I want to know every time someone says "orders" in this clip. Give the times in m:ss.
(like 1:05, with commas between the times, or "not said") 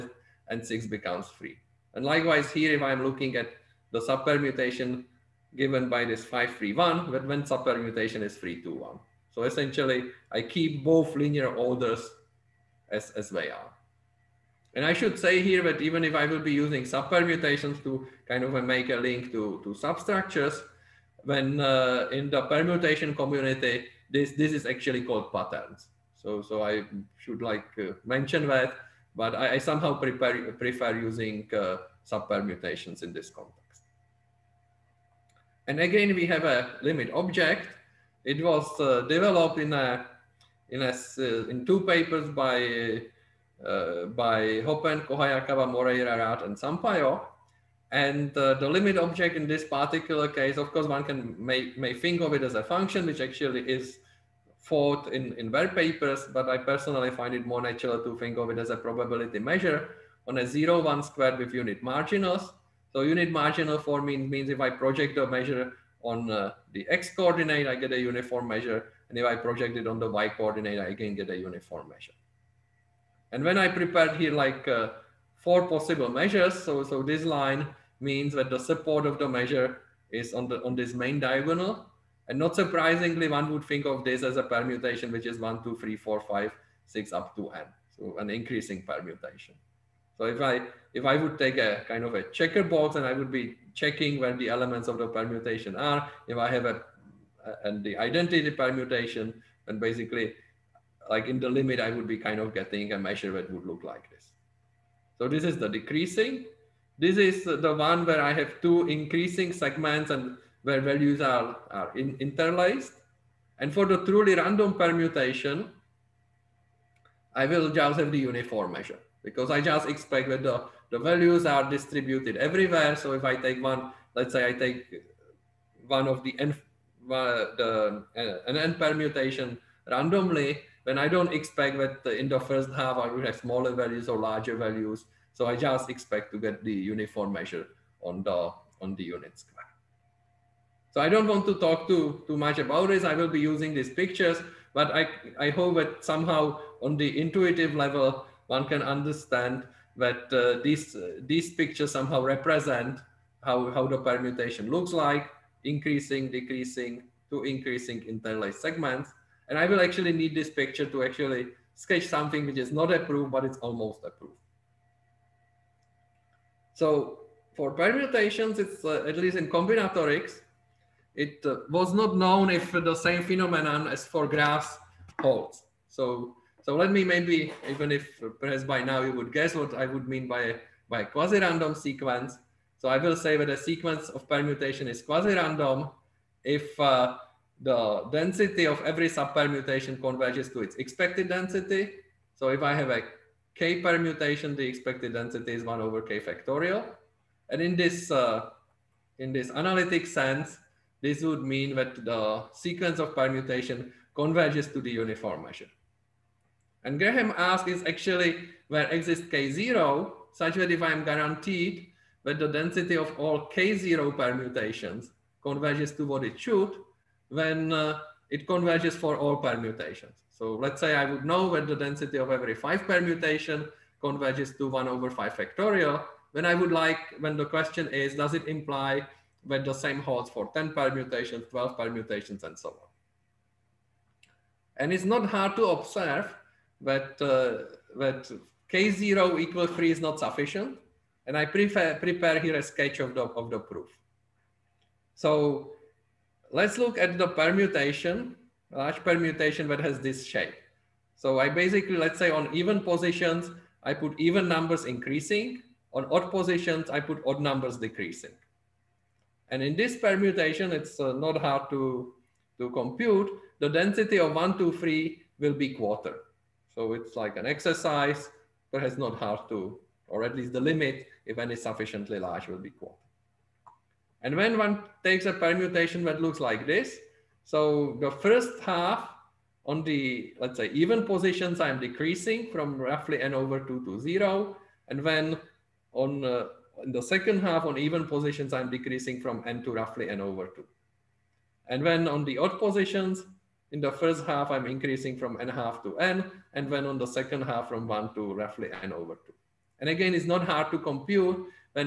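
0:11.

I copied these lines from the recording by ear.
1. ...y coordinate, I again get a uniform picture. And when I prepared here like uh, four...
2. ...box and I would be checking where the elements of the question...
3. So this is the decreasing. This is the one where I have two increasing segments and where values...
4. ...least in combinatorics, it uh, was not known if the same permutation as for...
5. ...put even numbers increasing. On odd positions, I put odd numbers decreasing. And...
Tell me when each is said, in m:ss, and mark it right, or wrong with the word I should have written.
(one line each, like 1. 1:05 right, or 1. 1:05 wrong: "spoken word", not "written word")
1. 1:10 wrong: "measure", not "picture"
2. 1:32 wrong: "permutation", not "question"
3. 1:45 right
4. 2:49 wrong: "phenomenon", not "permutation"
5. 4:13 right.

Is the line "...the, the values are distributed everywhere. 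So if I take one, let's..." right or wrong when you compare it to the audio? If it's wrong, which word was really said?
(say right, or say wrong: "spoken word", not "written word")
right.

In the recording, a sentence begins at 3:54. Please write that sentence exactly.
And it's not hard to observe that, uh, that K0 equal 3 is not sufficient.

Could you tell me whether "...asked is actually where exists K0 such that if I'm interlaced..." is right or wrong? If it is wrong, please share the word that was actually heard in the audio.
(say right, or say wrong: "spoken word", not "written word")
wrong: "guaranteed", not "interlaced".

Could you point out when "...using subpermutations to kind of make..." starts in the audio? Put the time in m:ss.
0:16.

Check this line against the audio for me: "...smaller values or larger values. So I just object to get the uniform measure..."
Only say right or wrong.
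wrong.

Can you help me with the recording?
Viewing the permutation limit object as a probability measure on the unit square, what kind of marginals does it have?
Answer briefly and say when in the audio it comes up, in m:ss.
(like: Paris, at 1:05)
unit marginals, at 1:01.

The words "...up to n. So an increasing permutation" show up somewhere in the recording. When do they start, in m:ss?
1:27.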